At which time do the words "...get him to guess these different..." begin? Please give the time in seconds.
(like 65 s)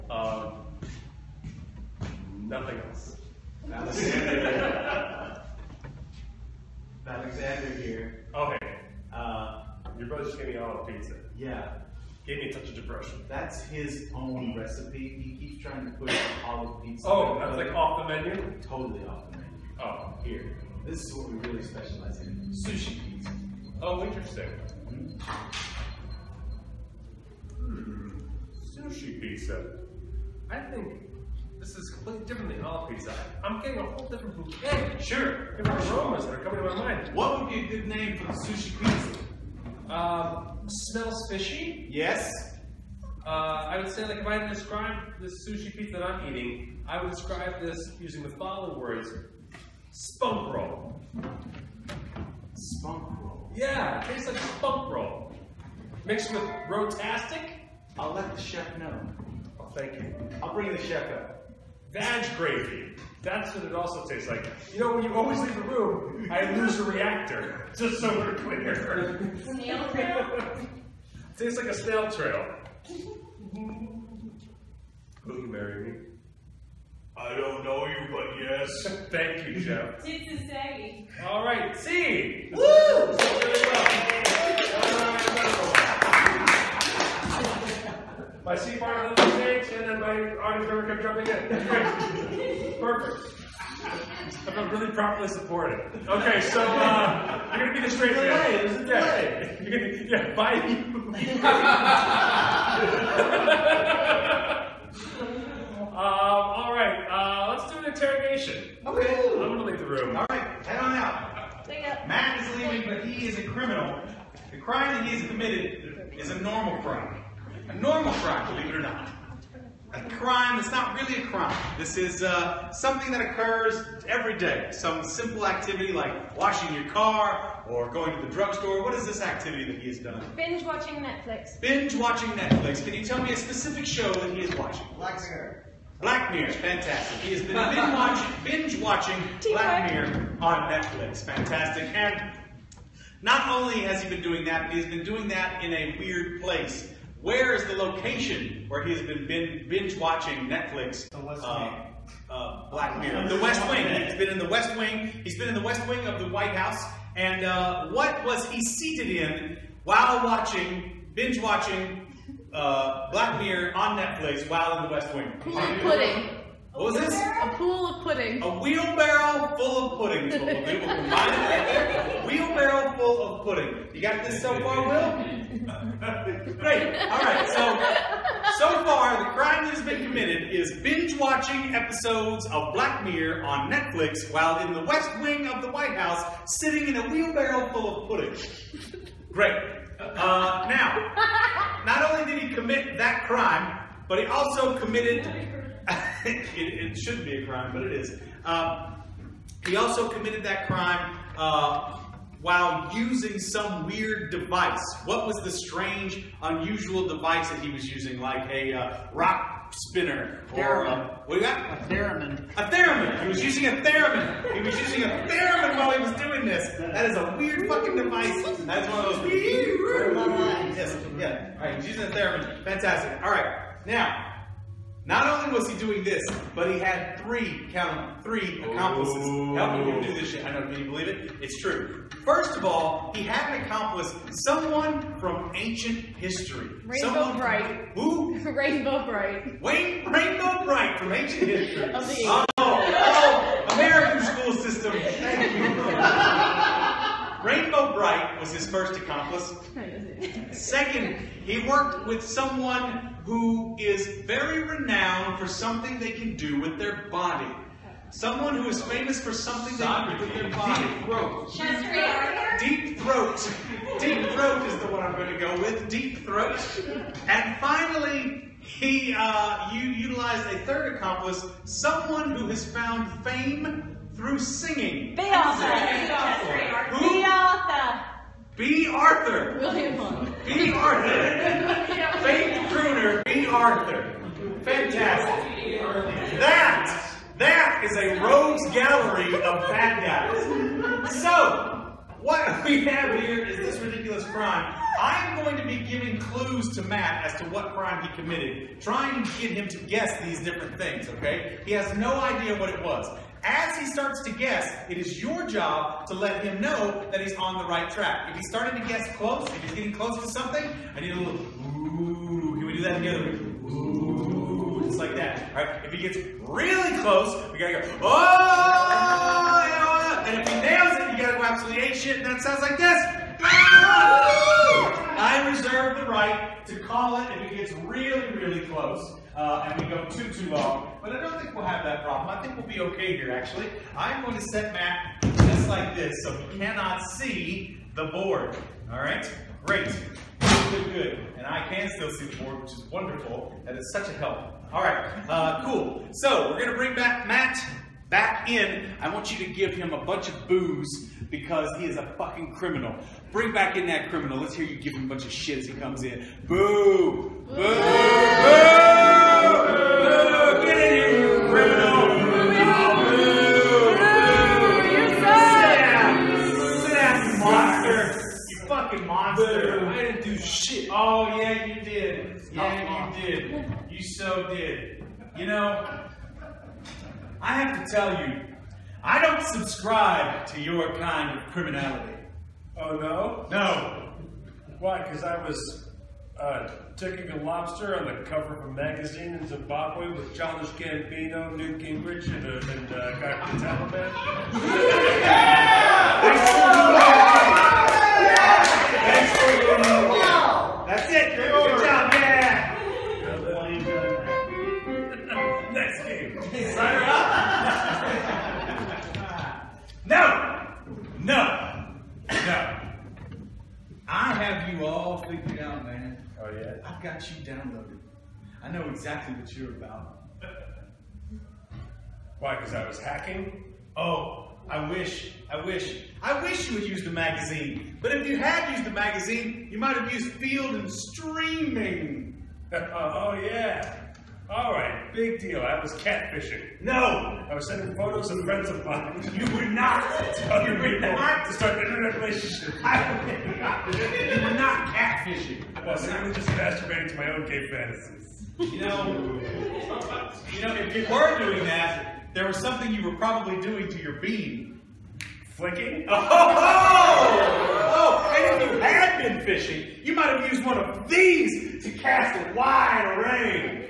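299 s.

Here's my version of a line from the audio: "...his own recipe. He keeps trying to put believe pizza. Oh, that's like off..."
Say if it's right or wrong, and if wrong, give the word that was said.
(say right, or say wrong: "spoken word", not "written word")
wrong: "olive", not "believe".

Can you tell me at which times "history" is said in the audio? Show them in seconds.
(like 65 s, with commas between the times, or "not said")
236 s, 241 s.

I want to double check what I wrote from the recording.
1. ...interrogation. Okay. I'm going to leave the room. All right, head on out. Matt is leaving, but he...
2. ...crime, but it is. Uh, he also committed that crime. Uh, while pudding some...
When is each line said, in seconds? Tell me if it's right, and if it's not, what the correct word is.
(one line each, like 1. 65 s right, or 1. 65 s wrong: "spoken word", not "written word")
1. 107 s right
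2. 197 s wrong: "using", not "pudding".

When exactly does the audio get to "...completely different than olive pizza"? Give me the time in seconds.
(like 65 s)
31 s.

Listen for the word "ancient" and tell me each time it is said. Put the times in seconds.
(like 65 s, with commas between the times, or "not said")
235 s, 241 s.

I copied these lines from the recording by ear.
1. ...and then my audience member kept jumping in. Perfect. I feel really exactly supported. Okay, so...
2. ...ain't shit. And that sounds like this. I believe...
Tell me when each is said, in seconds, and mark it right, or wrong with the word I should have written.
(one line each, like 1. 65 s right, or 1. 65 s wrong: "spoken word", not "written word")
1. 89 s wrong: "properly", not "exactly"
2. 321 s wrong: "reserve", not "believe".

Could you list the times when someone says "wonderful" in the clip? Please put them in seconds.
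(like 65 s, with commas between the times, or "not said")
342 s.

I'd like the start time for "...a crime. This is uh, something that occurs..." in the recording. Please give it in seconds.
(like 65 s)
121 s.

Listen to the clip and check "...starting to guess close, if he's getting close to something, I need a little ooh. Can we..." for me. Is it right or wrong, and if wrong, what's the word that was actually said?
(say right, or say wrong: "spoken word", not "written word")
right.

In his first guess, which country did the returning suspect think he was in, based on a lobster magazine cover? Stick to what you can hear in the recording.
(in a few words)
Zimbabwe.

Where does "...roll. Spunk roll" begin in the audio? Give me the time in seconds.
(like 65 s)
50 s.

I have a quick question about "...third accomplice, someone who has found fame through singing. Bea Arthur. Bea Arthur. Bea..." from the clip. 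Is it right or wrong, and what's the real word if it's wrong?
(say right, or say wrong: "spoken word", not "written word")
right.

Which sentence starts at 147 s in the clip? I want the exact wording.
Where is the location where he has been binge watching Netflix?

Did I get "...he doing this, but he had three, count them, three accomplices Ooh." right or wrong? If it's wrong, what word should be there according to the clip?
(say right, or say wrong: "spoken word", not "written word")
right.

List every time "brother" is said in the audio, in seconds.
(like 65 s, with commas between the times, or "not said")
10 s.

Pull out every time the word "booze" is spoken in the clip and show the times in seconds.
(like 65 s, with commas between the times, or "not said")
350 s.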